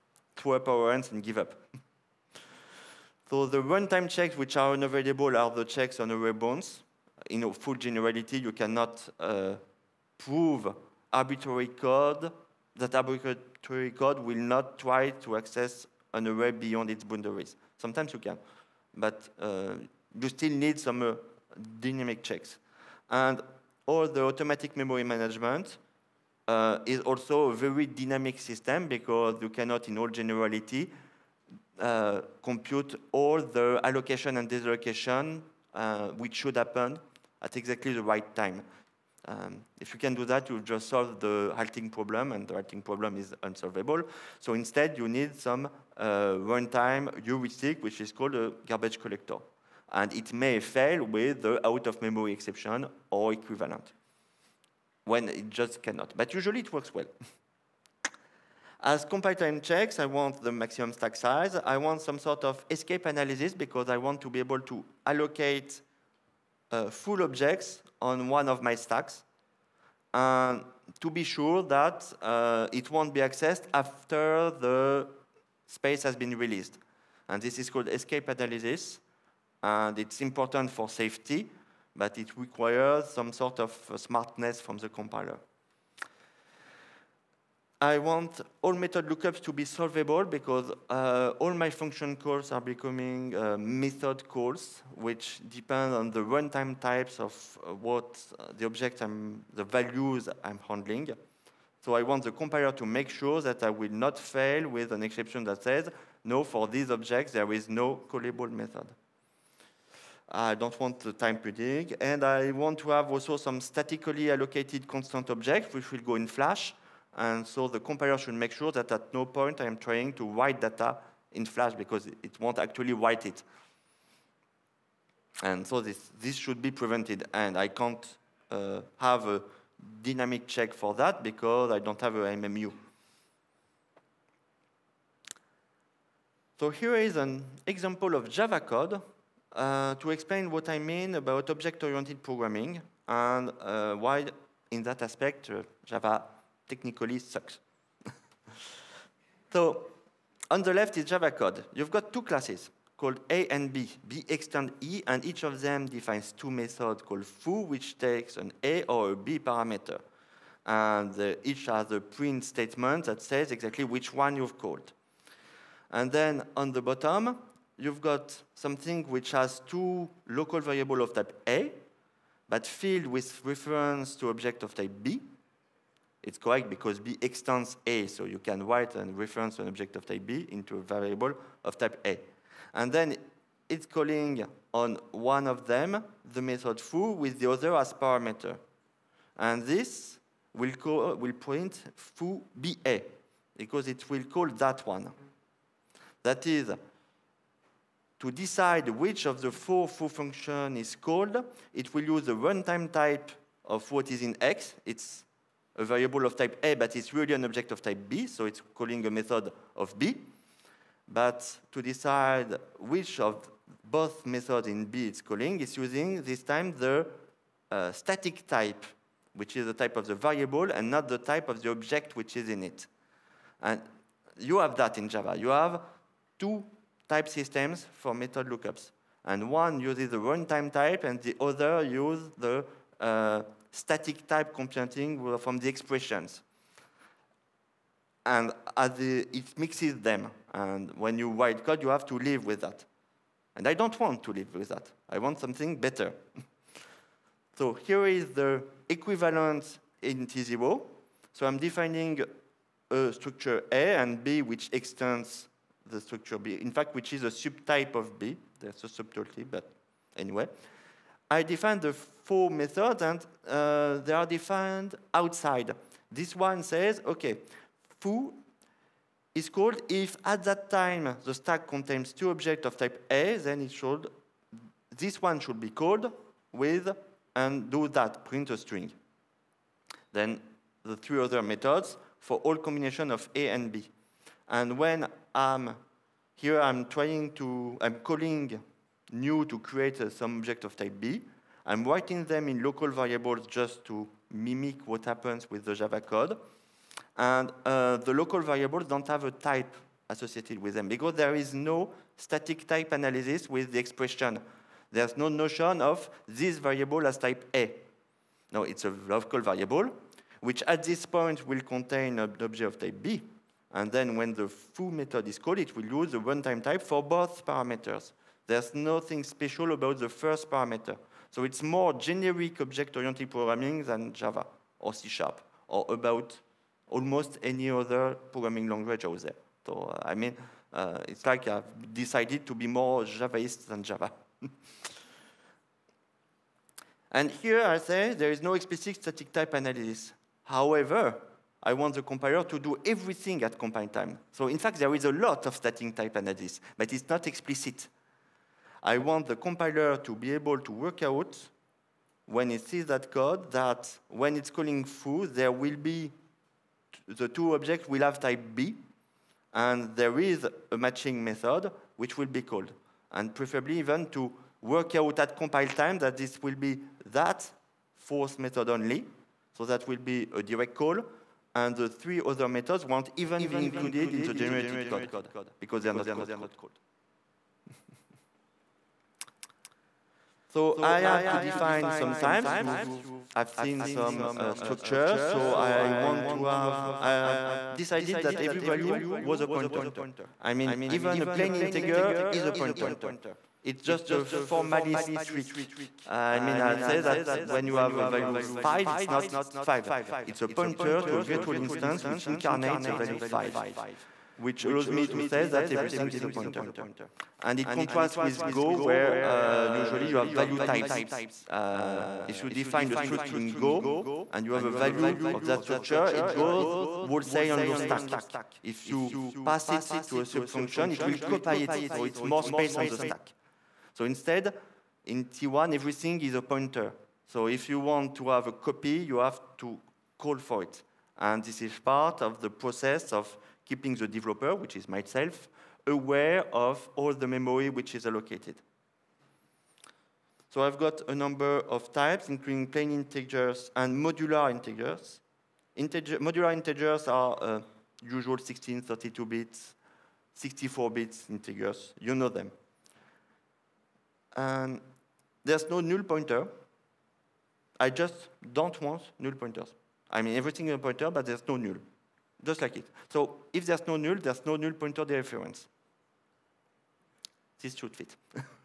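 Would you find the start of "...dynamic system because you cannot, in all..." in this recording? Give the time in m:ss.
0:27.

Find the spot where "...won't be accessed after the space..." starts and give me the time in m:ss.
1:12.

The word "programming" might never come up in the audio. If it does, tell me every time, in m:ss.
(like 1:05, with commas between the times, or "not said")
2:22, 5:23, 5:28.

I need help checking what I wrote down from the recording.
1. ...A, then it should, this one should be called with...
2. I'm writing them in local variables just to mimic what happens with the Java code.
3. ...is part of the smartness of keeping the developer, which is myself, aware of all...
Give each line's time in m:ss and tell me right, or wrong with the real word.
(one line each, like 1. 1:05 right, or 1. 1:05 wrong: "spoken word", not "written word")
1. 4:33 right
2. 4:51 right
3. 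7:11 wrong: "process", not "smartness".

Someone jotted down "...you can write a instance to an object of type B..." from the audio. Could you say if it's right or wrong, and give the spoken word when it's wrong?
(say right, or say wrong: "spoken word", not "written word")
wrong: "reference", not "instance".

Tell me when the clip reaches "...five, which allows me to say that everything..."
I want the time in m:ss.
6:43.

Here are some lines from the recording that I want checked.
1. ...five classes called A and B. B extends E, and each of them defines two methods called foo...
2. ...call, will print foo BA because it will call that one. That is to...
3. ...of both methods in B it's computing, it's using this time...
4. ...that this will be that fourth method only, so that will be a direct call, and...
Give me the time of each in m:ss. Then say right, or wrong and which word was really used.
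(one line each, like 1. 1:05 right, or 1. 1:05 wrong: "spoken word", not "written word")
1. 2:32 wrong: "two", not "five"
2. 3:10 right
3. 3:33 wrong: "calling", not "computing"
4. 6:05 right.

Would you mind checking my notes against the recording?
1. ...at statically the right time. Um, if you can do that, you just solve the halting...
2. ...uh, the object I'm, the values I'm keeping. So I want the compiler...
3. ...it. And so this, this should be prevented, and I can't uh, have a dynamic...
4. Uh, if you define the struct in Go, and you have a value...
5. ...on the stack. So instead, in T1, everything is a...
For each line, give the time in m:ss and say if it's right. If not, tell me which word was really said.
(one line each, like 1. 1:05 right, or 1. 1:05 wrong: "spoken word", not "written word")
1. 0:37 wrong: "exactly", not "statically"
2. 1:38 wrong: "handling", not "keeping"
3. 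2:03 right
4. 6:51 right
5. 7:02 right.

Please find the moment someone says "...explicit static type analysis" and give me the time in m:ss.
5:38.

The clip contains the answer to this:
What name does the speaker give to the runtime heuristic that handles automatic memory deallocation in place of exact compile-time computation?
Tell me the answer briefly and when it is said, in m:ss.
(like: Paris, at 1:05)
garbage collector, at 0:48.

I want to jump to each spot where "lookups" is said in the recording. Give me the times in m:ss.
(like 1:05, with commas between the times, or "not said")
1:29, 3:48.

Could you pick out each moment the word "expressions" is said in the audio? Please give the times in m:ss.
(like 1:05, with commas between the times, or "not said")
3:55, 5:03.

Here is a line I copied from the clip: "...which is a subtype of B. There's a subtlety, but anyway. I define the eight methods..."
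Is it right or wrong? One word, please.
wrong.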